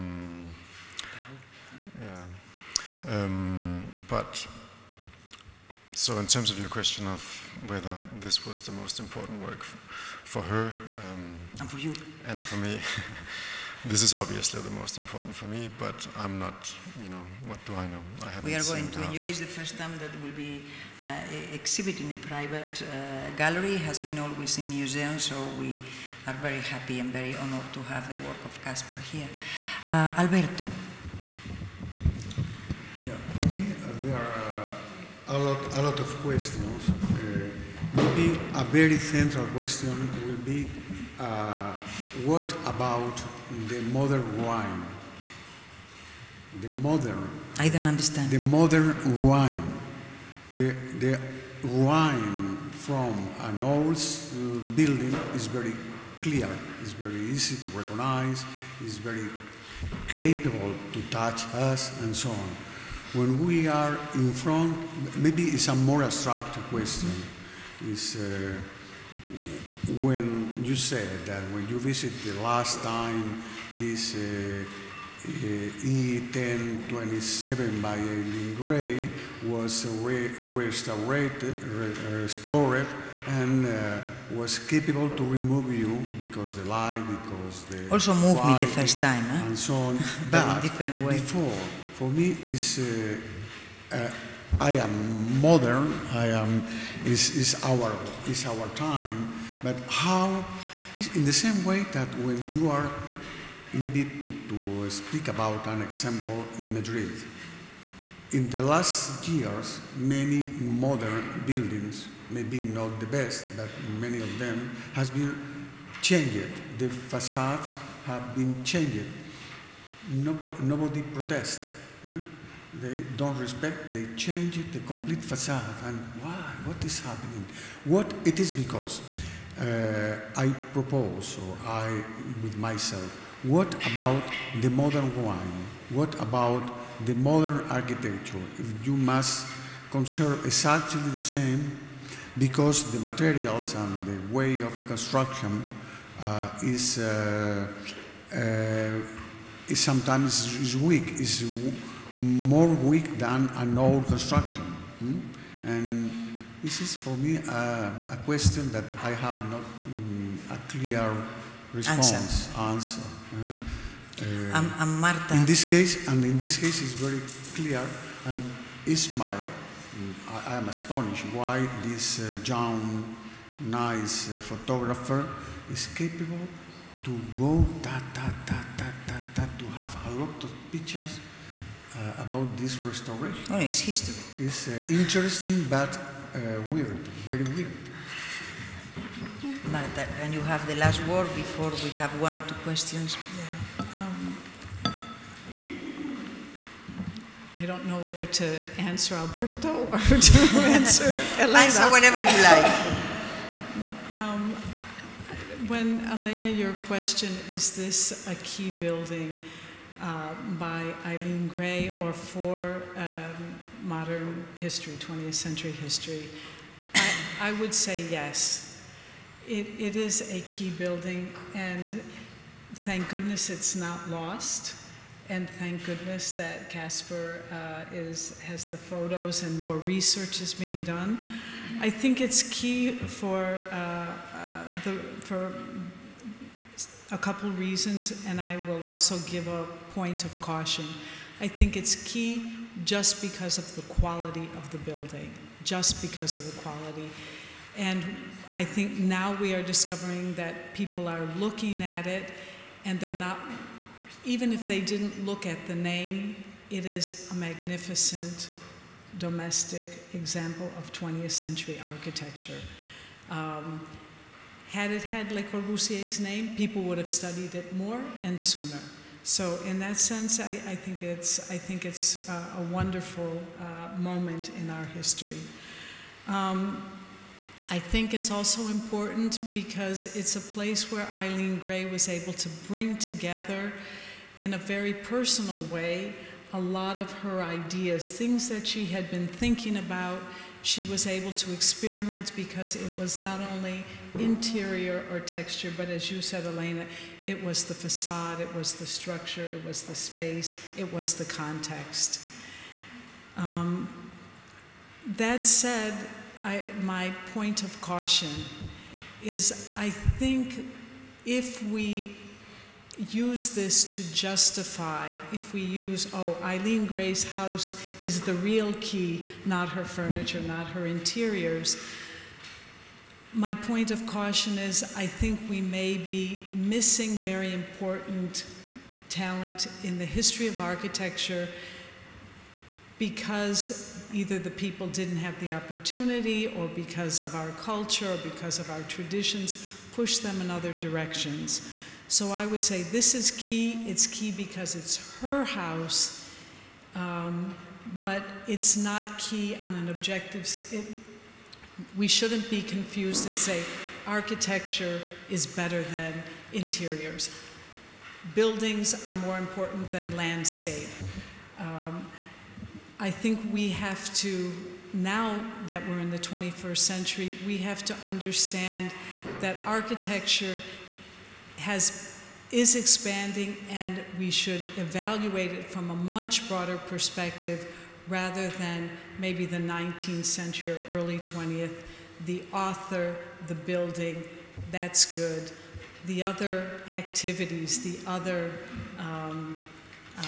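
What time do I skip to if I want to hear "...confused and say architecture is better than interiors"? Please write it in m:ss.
5:52.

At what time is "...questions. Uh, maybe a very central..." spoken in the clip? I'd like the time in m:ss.
0:36.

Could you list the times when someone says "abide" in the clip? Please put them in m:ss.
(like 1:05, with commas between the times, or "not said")
not said.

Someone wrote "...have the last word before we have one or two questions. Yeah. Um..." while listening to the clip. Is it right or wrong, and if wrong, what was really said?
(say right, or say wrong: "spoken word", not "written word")
right.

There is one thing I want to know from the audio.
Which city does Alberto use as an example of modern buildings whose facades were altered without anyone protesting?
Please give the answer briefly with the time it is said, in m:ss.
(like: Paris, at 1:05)
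Madrid, at 1:46.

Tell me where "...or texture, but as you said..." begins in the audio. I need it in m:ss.
4:55.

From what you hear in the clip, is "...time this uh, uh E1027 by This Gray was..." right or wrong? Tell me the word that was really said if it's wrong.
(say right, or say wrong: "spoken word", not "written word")
wrong: "Eileen", not "This".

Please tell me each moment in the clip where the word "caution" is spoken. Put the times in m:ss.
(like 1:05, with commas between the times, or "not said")
4:00, 5:07, 5:24.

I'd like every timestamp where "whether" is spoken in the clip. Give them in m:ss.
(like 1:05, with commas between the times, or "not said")
0:07, 3:17.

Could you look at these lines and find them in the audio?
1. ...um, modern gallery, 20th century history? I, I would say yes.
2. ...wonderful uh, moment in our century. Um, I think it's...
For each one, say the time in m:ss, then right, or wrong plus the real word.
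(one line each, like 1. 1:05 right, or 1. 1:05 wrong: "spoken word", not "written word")
1. 3:32 wrong: "history", not "gallery"
2. 4:32 wrong: "history", not "century".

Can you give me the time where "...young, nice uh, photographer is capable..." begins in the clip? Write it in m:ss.
2:52.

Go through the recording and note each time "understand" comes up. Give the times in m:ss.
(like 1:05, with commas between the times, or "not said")
0:47, 6:08.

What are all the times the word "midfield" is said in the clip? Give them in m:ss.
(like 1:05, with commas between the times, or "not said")
not said.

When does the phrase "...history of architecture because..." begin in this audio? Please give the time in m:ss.
5:30.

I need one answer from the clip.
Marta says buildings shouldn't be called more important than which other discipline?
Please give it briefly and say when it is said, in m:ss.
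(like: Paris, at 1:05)
landscape, at 6:00.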